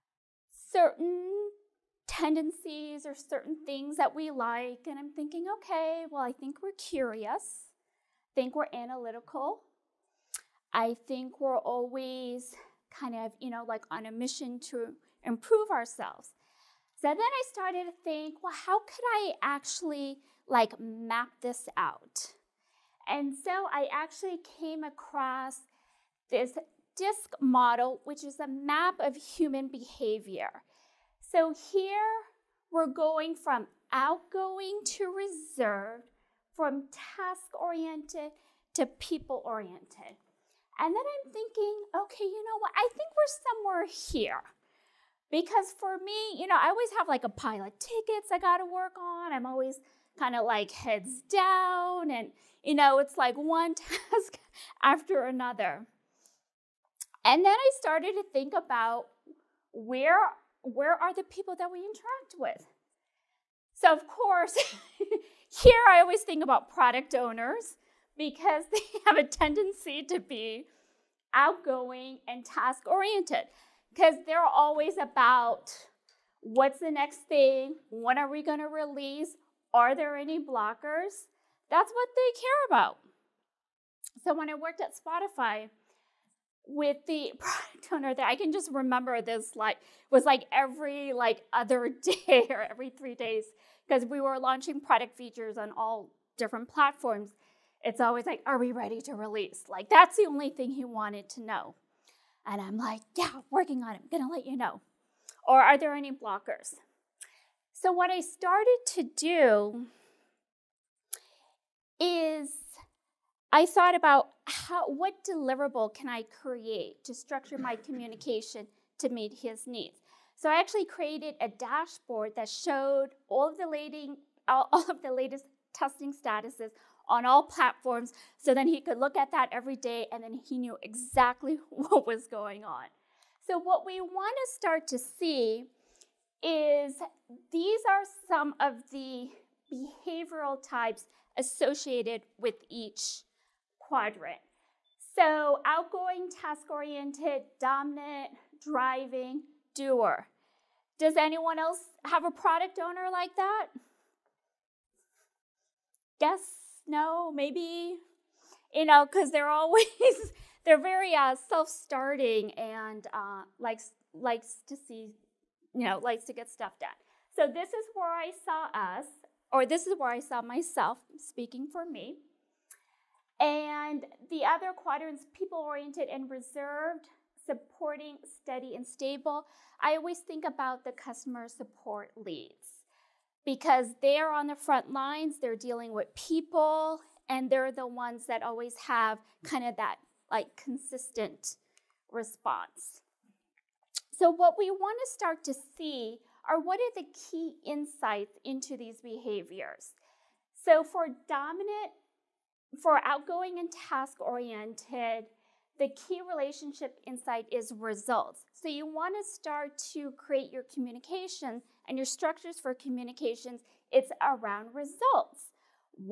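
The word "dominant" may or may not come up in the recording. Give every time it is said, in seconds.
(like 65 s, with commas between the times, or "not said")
147 s, 201 s.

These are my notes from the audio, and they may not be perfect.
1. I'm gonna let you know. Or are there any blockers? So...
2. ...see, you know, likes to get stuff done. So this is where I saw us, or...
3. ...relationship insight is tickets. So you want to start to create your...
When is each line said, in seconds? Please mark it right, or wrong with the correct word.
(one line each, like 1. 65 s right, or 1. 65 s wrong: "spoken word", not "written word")
1. 104 s right
2. 164 s right
3. 206 s wrong: "results", not "tickets".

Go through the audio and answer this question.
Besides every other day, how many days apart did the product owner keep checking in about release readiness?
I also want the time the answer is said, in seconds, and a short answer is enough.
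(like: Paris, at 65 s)
3, at 92 s.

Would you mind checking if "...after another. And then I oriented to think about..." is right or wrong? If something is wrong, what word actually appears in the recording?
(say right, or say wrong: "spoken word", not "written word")
wrong: "started", not "oriented".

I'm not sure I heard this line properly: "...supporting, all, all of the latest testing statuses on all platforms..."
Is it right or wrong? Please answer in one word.
wrong.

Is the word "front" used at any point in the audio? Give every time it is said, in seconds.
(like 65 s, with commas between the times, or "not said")
184 s.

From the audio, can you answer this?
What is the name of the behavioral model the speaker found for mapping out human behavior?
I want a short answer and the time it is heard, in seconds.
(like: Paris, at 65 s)
DISC, at 26 s.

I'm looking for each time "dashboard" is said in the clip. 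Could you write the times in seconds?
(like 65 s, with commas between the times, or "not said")
121 s.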